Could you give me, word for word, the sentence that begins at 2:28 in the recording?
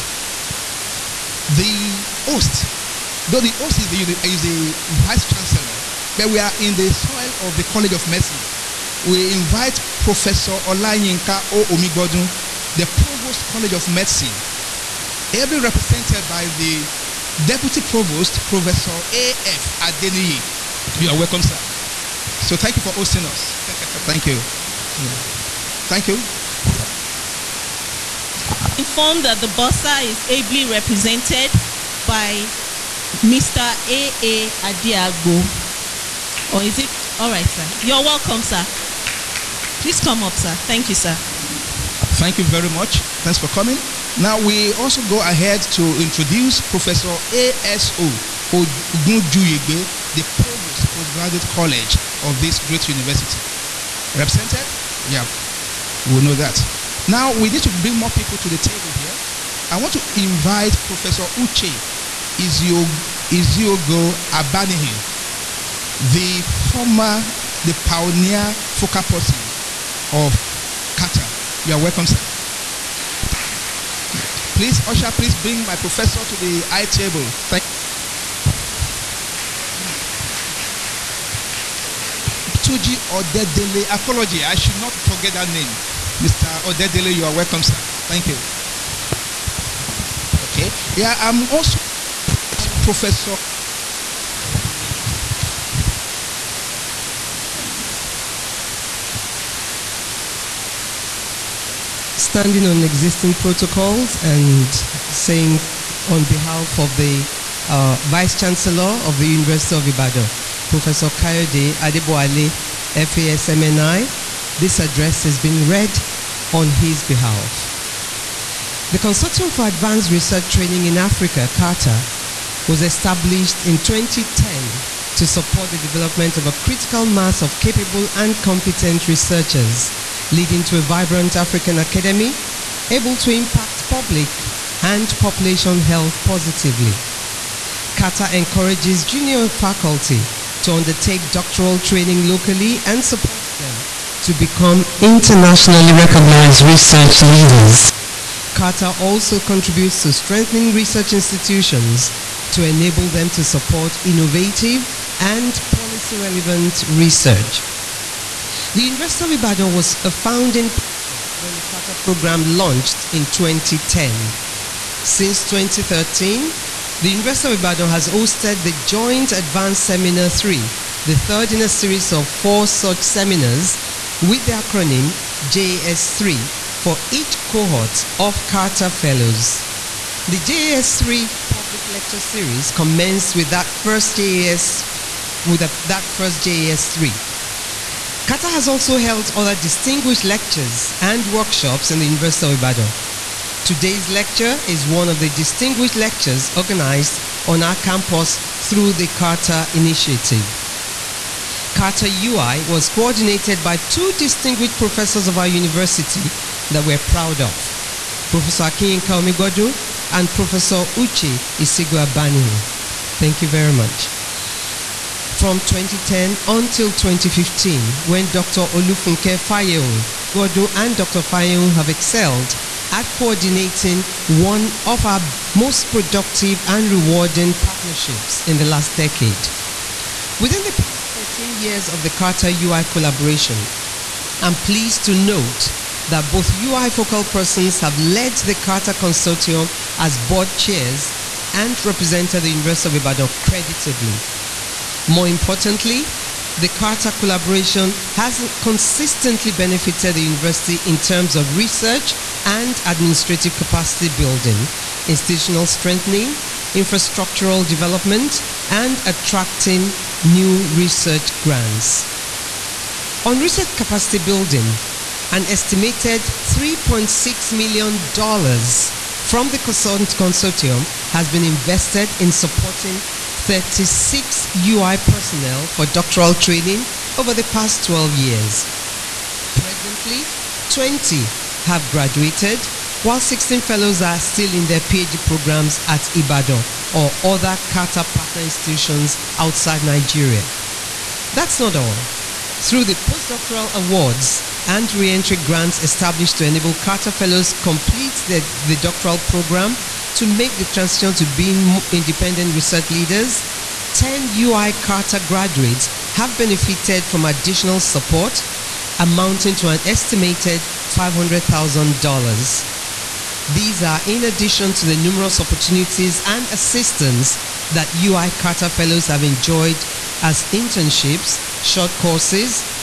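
CARTA also contributes to strengthening research institutions to enable them to support innovative and policy relevant research.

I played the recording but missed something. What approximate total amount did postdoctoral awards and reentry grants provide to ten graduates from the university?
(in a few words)
$500,000.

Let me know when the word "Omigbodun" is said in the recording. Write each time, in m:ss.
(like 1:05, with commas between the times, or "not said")
0:11, 3:29.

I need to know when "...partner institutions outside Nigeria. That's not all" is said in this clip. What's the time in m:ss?
4:48.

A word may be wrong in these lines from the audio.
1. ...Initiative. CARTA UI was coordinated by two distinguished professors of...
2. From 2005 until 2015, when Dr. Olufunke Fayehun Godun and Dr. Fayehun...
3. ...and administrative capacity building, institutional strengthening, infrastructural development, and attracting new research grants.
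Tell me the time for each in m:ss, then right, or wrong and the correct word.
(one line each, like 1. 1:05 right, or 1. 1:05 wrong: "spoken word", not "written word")
1. 3:19 right
2. 3:35 wrong: "2010", not "2005"
3. 4:12 right.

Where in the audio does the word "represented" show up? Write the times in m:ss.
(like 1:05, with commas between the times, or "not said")
0:15, 0:30, 0:54, 4:01.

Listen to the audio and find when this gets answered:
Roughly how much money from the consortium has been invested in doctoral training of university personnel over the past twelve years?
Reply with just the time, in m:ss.
4:26.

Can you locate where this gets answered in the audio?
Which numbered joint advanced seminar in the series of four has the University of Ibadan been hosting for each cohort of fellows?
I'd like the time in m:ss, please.
2:48.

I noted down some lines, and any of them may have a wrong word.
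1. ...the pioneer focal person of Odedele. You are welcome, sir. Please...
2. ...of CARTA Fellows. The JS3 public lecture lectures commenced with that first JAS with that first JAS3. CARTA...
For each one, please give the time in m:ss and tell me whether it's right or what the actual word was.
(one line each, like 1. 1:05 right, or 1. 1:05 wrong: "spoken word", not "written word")
1. 1:07 wrong: "CARTA", not "Odedele"
2. 2:58 wrong: "series", not "lectures".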